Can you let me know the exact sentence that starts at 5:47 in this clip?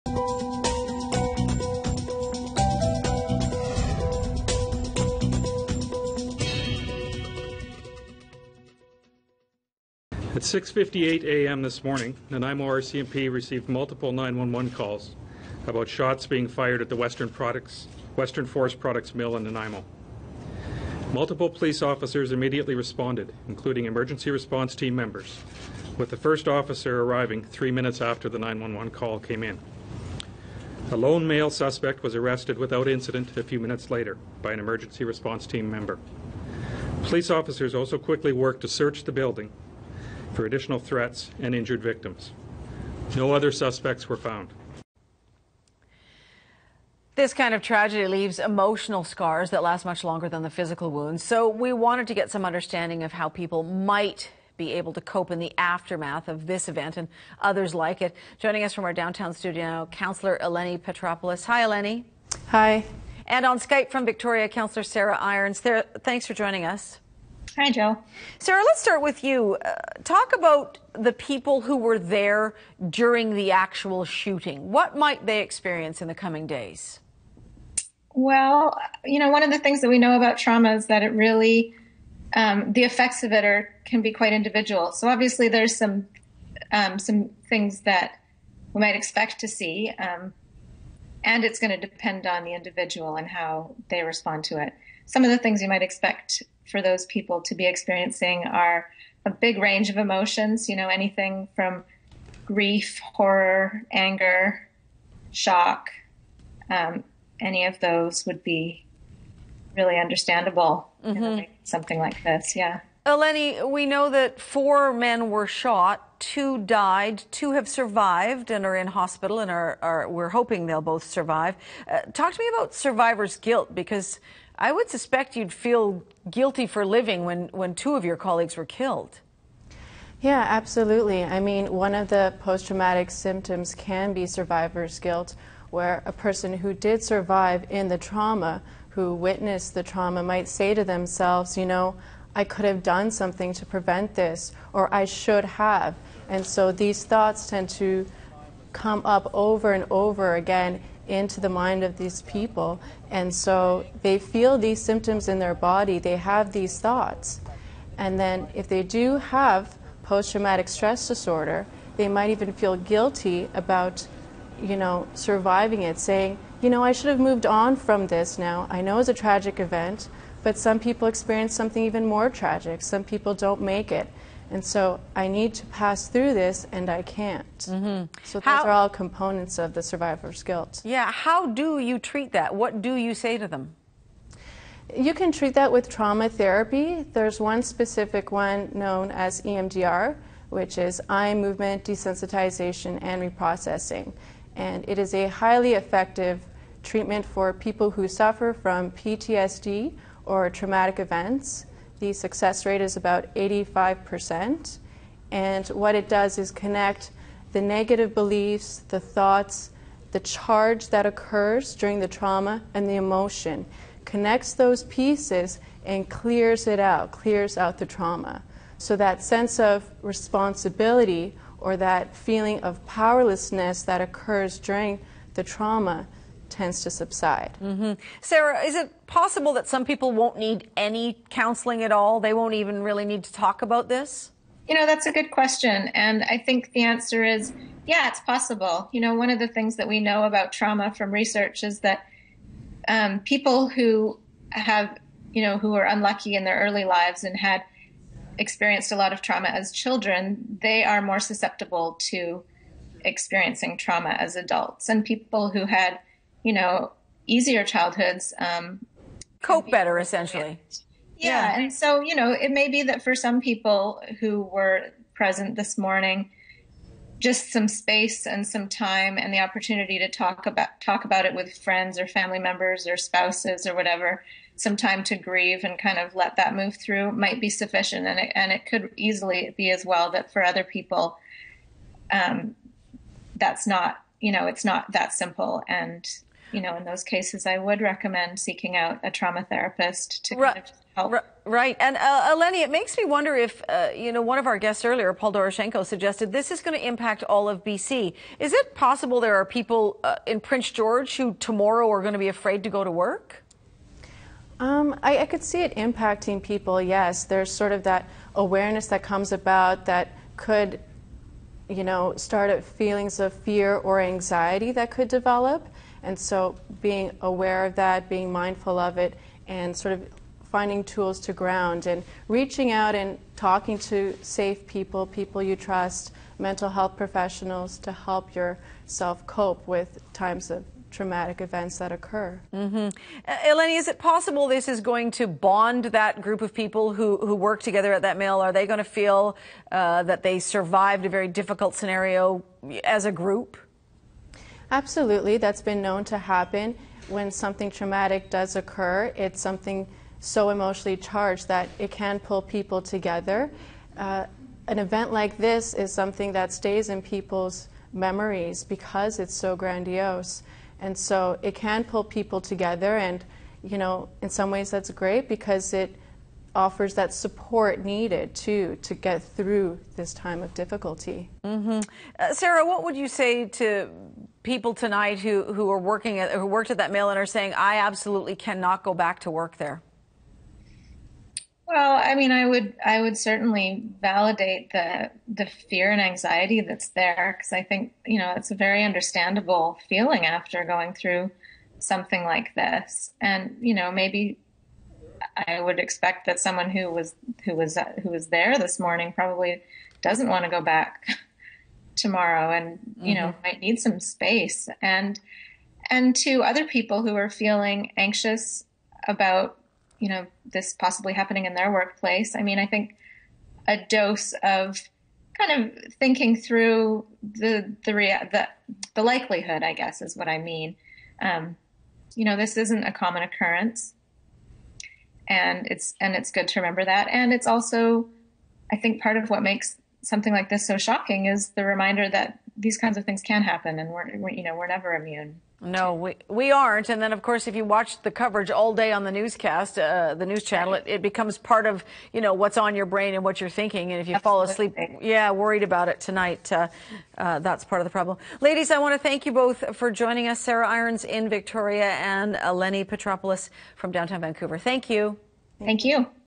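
When something traumatic does occur, it's something so emotionally charged that it can pull people together.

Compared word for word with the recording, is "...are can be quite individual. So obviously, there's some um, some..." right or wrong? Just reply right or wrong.
right.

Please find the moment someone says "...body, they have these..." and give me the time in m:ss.
2:35.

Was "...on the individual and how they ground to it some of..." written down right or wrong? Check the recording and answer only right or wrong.
wrong.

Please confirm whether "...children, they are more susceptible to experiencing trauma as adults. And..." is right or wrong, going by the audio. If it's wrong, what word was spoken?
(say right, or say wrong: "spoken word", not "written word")
right.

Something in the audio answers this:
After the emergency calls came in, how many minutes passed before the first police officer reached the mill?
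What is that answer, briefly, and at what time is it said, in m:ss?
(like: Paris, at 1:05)
3 minutes, at 0:27.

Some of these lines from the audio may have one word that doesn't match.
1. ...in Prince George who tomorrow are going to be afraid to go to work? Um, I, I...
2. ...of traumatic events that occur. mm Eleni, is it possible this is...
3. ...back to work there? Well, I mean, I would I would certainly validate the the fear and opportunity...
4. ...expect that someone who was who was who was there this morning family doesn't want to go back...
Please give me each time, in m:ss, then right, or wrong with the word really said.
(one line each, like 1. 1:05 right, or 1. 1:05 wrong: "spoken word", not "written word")
1. 5:00 right
2. 5:30 right
3. 6:18 wrong: "anxiety", not "opportunity"
4. 6:35 wrong: "probably", not "family".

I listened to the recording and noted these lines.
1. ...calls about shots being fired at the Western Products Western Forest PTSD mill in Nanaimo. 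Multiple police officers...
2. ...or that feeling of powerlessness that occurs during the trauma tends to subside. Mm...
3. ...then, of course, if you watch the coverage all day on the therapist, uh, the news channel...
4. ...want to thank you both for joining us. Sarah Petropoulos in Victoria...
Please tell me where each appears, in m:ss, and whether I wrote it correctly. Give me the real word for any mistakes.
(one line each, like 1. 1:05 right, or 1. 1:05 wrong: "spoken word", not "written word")
1. 0:14 wrong: "Products", not "PTSD"
2. 3:41 right
3. 7:16 wrong: "newscast", not "therapist"
4. 7:28 wrong: "Irons", not "Petropoulos".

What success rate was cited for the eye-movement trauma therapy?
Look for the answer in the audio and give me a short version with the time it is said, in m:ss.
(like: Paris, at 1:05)
85%, at 3:23.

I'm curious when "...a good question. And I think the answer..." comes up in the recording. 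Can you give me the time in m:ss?
3:55.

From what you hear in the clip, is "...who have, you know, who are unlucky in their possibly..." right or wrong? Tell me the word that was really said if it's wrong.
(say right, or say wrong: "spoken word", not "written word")
wrong: "early", not "possibly".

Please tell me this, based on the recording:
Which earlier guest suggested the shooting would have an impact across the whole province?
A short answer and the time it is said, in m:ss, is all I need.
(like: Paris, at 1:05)
Paul Doroshenko, at 4:55.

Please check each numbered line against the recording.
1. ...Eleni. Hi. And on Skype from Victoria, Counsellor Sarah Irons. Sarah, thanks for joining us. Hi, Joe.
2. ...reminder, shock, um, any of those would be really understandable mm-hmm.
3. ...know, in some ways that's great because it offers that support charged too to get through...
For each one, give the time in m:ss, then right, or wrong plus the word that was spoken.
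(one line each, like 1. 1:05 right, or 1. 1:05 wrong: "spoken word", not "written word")
1. 1:01 right
2. 1:43 wrong: "anger", not "reminder"
3. 6:03 wrong: "needed", not "charged".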